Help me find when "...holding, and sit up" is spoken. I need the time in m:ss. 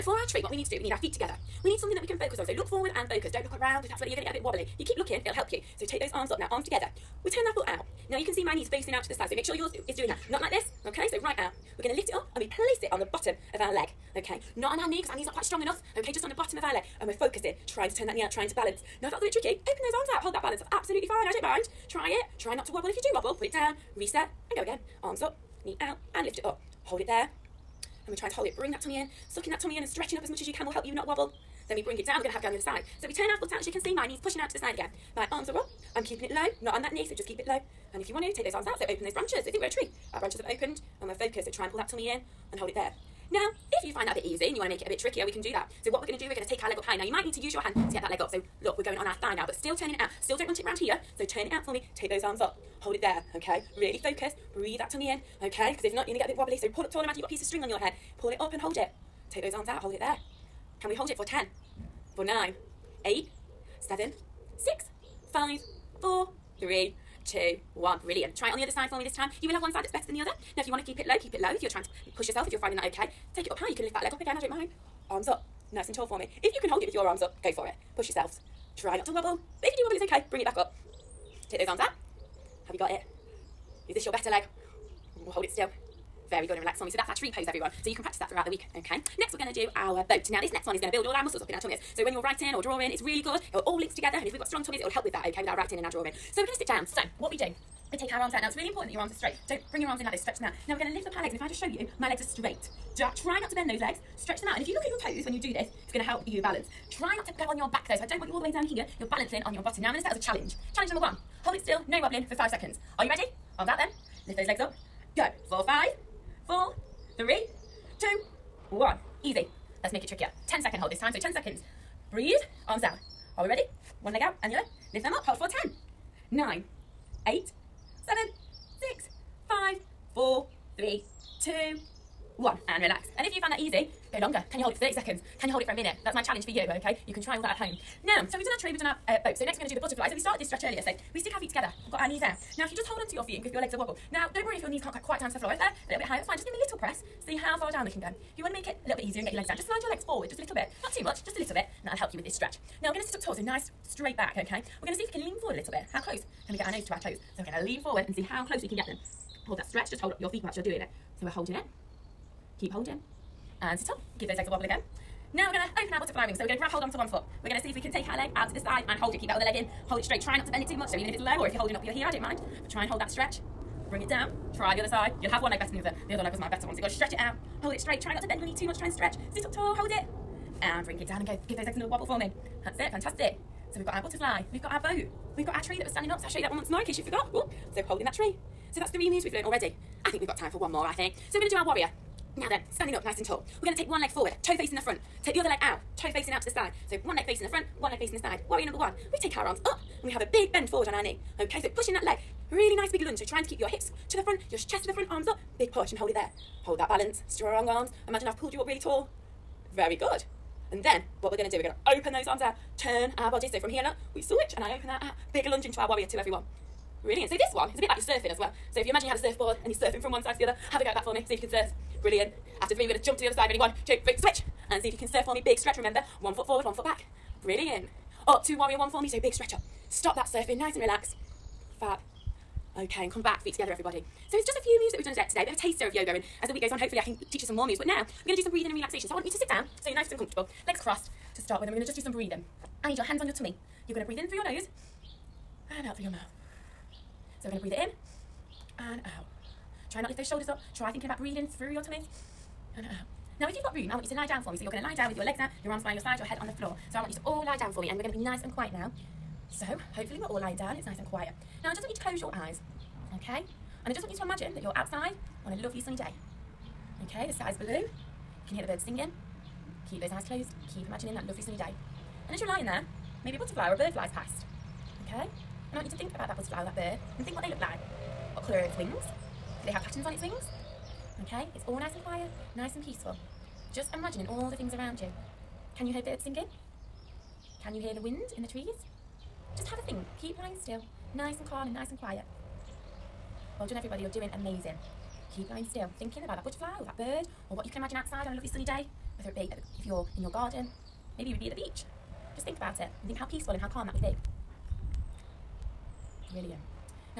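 2:42.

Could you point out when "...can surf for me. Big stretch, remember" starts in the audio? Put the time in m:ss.
3:44.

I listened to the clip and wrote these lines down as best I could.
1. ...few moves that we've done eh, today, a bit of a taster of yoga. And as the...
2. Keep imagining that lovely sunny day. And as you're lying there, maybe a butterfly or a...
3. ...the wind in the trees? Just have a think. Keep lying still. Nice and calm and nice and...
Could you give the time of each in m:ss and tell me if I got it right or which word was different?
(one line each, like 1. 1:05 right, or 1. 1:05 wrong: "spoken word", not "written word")
1. 3:54 right
2. 4:30 right
3. 4:47 right.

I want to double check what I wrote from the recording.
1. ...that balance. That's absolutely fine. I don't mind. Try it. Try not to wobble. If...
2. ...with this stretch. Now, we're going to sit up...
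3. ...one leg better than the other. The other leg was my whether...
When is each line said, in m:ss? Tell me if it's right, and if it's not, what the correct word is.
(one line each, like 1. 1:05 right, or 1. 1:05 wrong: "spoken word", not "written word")
1. 0:20 right
2. 2:32 right
3. 2:55 wrong: "better", not "whether".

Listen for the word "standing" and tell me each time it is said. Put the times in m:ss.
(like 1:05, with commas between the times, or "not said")
3:05, 3:12.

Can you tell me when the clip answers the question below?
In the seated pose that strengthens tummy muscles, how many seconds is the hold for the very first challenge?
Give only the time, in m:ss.
1:52.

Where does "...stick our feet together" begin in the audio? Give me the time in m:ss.
2:21.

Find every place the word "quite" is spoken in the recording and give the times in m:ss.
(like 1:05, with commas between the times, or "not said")
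0:15, 2:25.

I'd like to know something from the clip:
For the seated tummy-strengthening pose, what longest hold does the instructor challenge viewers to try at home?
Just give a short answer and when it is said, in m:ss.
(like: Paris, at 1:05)
a minute, at 2:15.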